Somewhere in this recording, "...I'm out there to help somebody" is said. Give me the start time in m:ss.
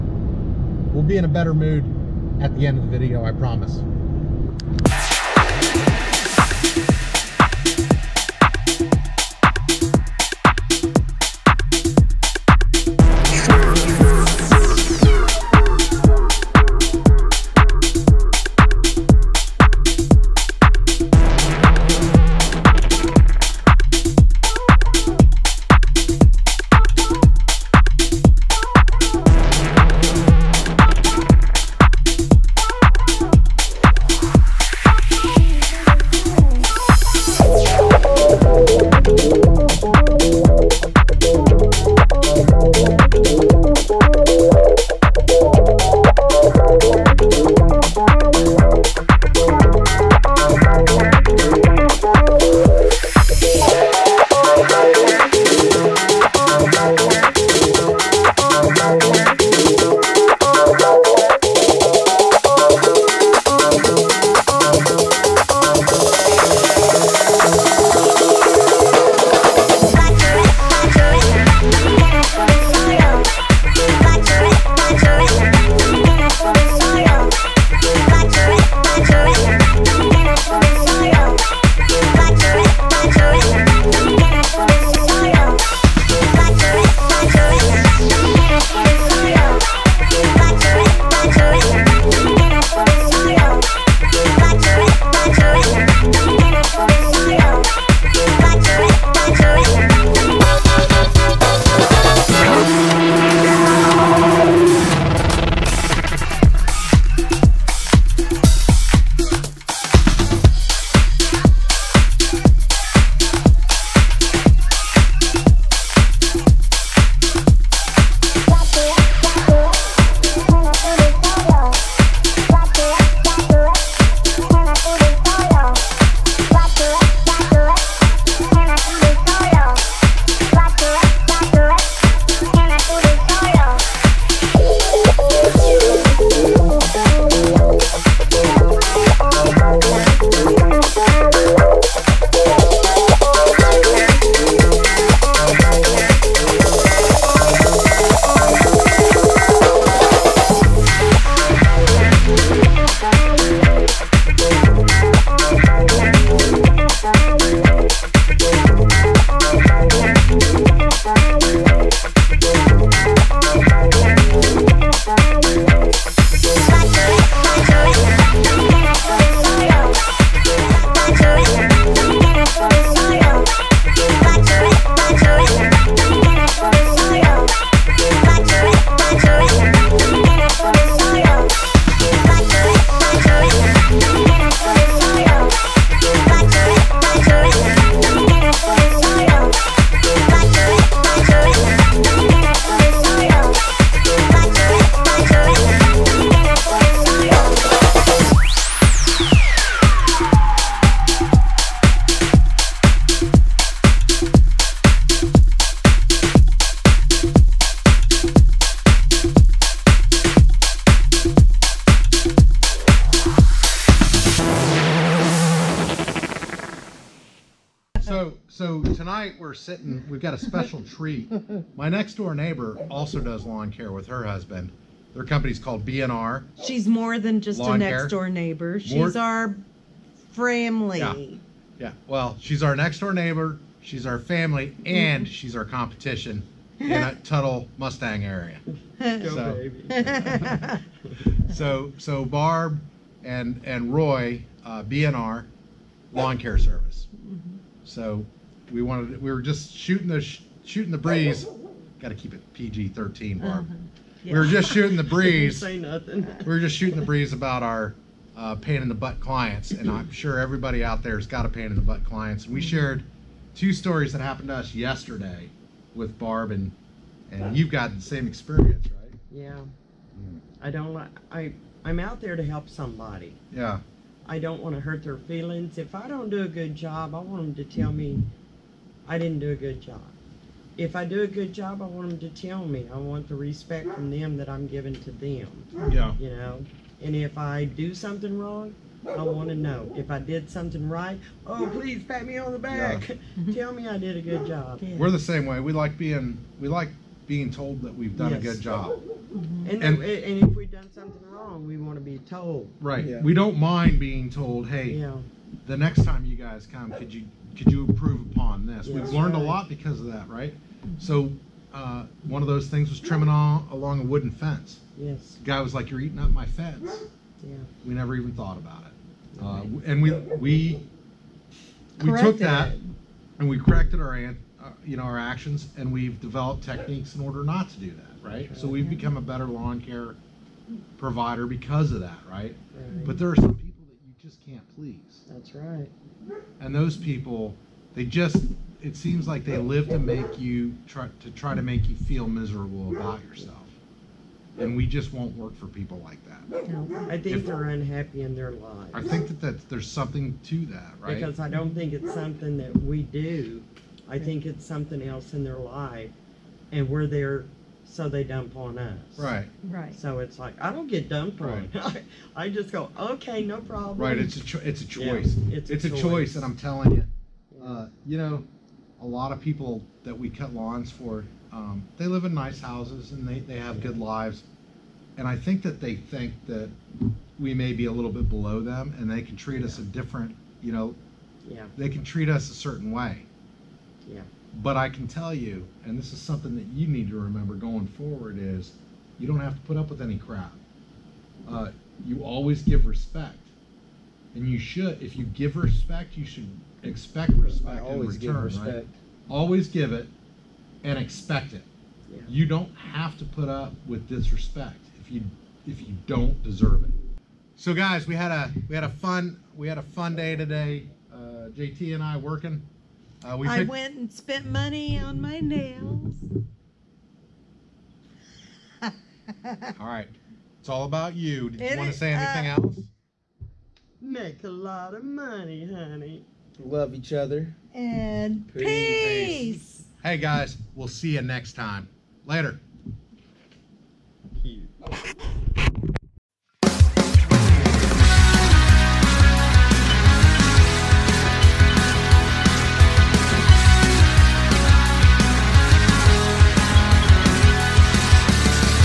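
4:31.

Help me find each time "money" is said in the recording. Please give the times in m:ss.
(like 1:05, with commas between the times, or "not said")
6:54, 7:05.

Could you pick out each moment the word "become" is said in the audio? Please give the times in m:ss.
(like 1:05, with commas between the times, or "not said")
5:28.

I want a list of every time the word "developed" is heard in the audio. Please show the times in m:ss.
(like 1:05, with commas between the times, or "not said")
5:26.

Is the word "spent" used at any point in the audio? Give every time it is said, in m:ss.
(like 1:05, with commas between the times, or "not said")
6:54.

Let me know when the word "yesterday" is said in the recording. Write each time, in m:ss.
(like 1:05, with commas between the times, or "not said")
4:24.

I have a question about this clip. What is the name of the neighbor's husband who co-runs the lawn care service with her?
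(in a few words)
Roy.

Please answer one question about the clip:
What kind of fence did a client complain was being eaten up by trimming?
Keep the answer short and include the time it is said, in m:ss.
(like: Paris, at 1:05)
Wooden fence, at 5:14.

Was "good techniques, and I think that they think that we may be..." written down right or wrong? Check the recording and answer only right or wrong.
wrong.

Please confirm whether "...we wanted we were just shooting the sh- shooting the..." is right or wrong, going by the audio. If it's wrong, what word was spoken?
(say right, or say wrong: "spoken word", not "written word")
right.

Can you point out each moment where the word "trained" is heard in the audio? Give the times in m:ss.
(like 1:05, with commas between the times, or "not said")
not said.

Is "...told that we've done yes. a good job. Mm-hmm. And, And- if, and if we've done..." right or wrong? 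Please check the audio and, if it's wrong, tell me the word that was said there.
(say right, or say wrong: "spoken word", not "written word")
right.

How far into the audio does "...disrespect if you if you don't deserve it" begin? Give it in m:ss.
6:44.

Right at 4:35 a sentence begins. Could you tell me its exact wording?
If I don't do a good job, I want them to tell me I didn't do a good job.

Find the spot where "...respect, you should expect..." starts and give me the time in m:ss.
6:35.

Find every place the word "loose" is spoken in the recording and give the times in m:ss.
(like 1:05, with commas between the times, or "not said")
not said.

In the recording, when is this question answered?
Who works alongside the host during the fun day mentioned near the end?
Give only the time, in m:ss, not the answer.
6:51.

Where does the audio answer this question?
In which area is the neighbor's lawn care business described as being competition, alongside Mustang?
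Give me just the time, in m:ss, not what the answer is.
3:57.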